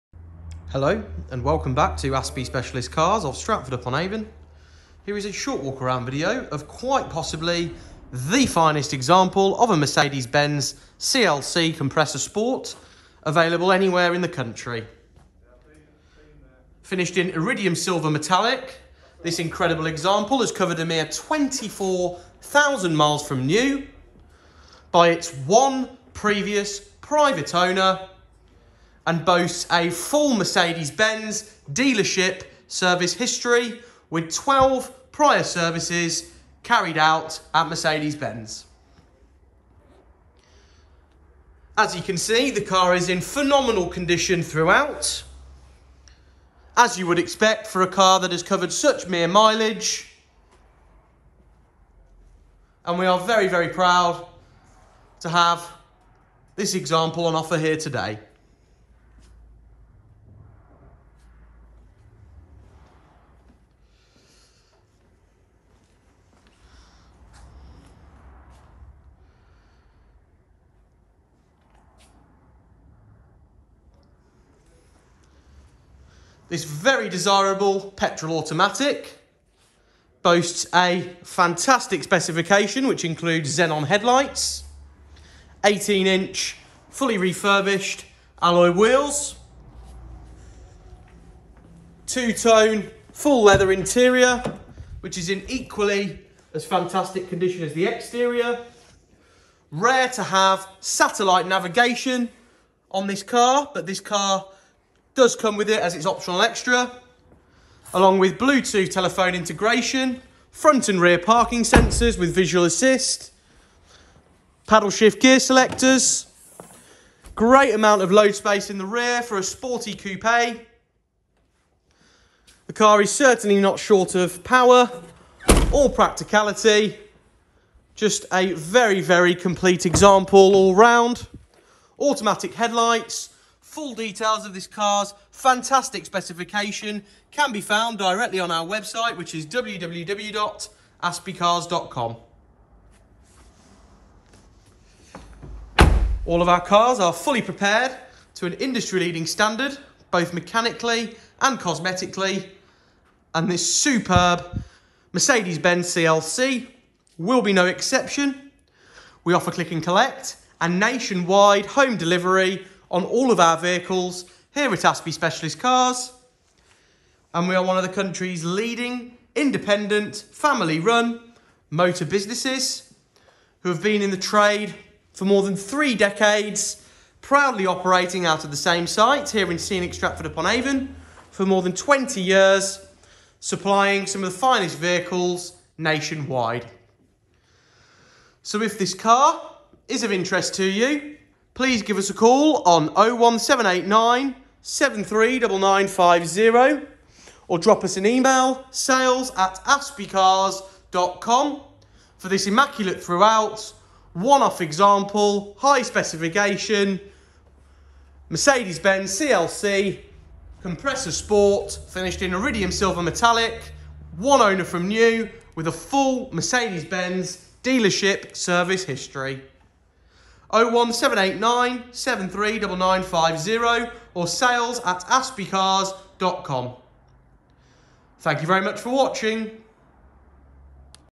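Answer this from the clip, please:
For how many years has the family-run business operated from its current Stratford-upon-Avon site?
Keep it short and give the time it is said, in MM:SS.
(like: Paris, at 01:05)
More than 20 years, at 03:01.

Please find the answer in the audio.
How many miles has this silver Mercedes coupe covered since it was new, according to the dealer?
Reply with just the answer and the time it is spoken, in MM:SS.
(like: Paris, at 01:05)
24,000, at 00:21.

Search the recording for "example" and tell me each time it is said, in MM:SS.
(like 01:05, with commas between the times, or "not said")
00:08, 00:19, 00:56, 02:09, 03:24.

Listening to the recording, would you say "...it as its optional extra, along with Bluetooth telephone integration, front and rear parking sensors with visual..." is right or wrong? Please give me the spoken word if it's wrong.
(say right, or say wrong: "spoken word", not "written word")
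right.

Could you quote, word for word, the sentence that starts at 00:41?
As you can see, the car is in phenomenal condition throughout.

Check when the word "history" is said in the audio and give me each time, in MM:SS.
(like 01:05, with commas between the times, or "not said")
00:33, 03:38.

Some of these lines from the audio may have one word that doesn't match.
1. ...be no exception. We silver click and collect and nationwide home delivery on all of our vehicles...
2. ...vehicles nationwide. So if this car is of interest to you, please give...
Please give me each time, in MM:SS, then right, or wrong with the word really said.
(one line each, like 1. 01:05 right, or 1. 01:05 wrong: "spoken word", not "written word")
1. 02:37 wrong: "offer", not "silver"
2. 03:04 right.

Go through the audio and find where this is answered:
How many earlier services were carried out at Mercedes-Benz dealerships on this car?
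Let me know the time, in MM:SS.
00:34.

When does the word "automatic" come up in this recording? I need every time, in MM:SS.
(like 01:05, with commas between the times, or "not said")
01:18, 02:11.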